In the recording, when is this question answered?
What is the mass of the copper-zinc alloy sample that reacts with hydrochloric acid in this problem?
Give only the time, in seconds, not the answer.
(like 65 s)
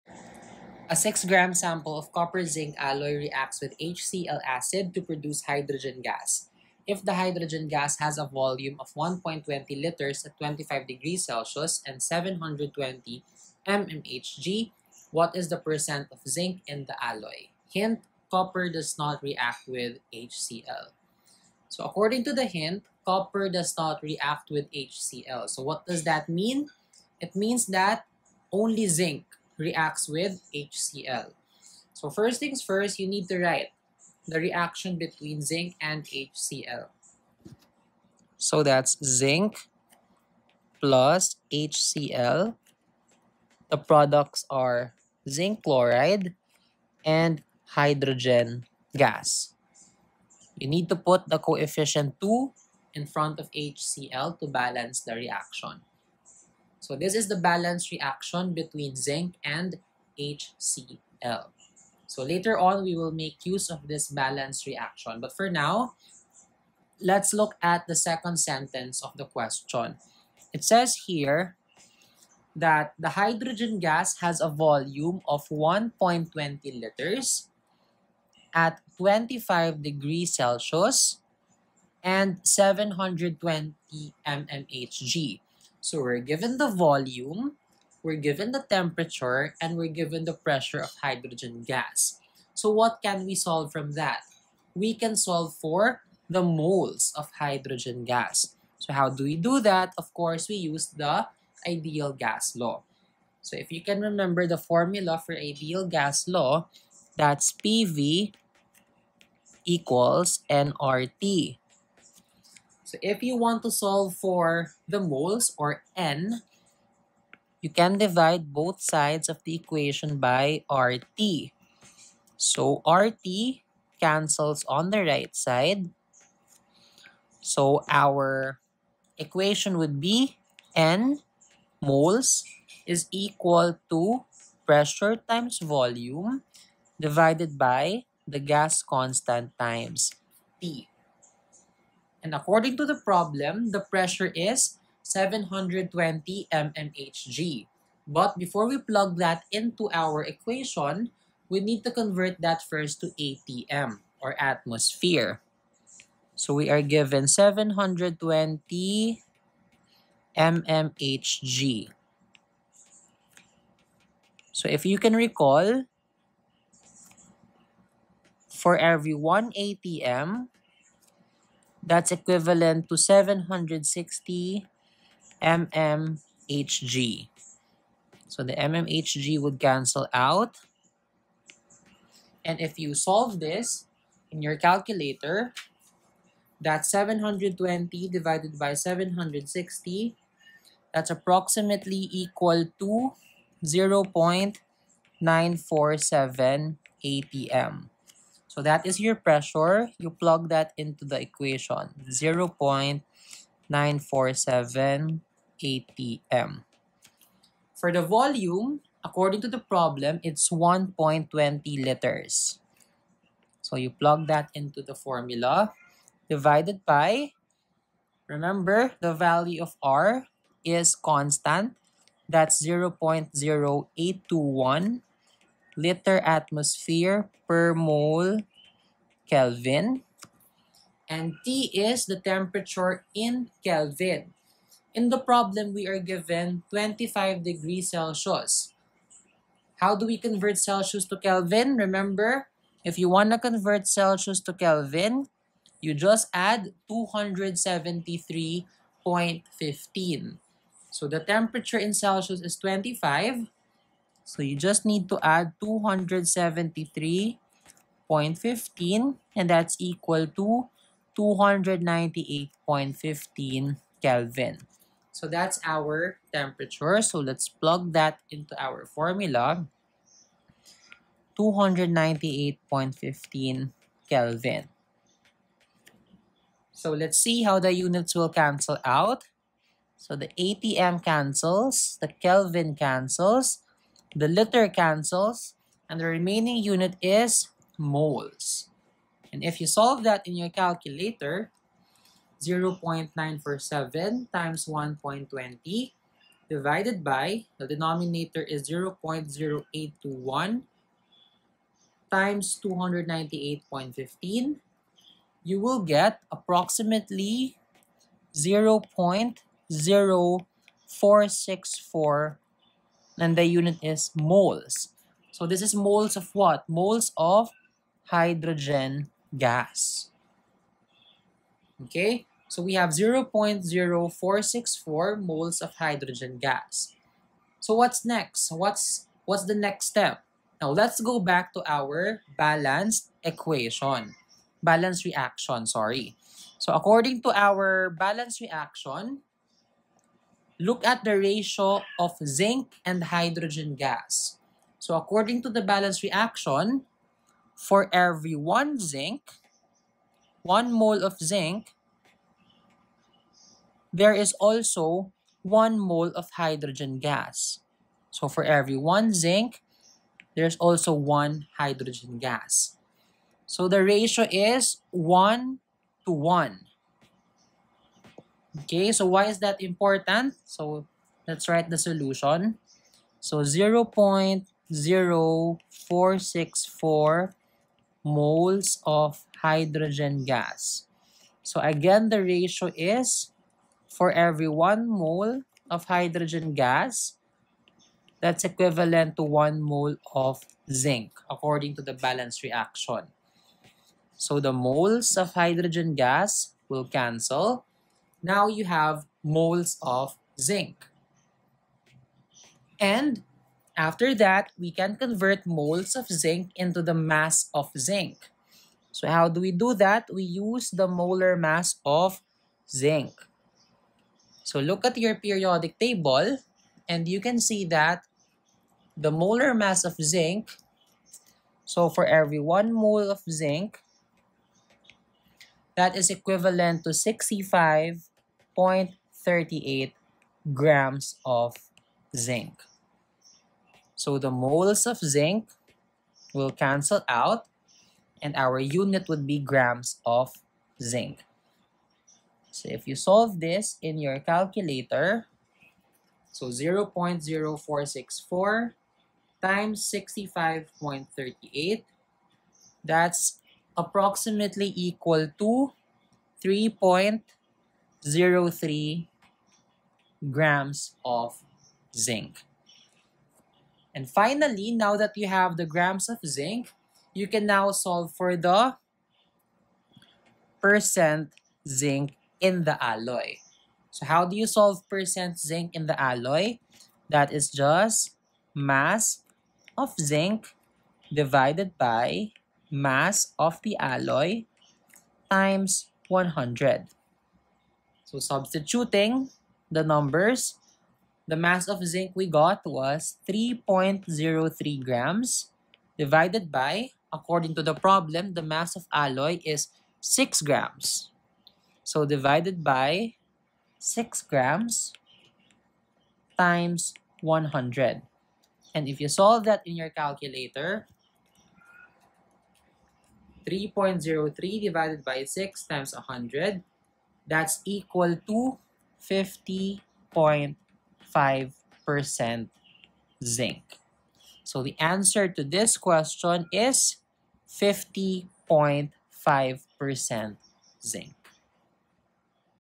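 0 s.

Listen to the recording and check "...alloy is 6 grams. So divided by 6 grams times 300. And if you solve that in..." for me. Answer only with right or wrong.
wrong.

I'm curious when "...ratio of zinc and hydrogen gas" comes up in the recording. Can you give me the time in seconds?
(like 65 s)
341 s.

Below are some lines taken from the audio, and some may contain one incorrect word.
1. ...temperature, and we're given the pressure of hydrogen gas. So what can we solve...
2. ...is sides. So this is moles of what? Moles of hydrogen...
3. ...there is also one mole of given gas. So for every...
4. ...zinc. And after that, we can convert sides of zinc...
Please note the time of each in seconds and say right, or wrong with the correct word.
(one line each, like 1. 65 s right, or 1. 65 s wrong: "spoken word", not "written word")
1. 88 s right
2. 313 s wrong: "moles", not "sides"
3. 353 s wrong: "hydrogen", not "given"
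4. 400 s wrong: "moles", not "sides".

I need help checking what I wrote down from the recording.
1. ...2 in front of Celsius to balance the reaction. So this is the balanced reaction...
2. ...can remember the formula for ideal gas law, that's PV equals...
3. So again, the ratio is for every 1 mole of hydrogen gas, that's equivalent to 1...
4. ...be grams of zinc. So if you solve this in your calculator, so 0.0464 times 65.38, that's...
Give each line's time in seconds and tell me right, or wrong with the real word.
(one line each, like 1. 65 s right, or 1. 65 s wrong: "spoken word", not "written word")
1. 52 s wrong: "HCl", not "Celsius"
2. 103 s right
3. 381 s right
4. 439 s right.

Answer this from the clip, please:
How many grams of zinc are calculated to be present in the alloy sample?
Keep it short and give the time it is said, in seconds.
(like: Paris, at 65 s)
3.03 grams, at 493 s.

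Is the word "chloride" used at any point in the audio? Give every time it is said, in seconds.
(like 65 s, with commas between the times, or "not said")
45 s.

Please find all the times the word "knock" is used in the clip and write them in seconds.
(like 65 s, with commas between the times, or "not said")
not said.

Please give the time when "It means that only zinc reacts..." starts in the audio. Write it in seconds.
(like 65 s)
27 s.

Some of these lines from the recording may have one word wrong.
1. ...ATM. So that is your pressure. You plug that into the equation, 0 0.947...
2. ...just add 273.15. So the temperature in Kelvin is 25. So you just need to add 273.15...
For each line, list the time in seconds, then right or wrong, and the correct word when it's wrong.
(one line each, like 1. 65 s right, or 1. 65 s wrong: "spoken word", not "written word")
1. 197 s right
2. 245 s wrong: "Celsius", not "Kelvin".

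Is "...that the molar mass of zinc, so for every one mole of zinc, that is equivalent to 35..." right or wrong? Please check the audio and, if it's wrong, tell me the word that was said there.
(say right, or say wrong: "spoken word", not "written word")
wrong: "65", not "35".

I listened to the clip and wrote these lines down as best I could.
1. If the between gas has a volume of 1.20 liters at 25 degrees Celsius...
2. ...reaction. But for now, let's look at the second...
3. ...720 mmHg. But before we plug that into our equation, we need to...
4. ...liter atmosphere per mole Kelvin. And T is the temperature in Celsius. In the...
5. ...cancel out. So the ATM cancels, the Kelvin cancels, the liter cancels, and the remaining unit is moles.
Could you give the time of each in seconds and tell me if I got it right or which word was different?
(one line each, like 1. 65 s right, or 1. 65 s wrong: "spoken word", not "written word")
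1. 6 s wrong: "hydrogen", not "between"
2. 64 s right
3. 145 s right
4. 225 s wrong: "Kelvin", not "Celsius"
5. 278 s right.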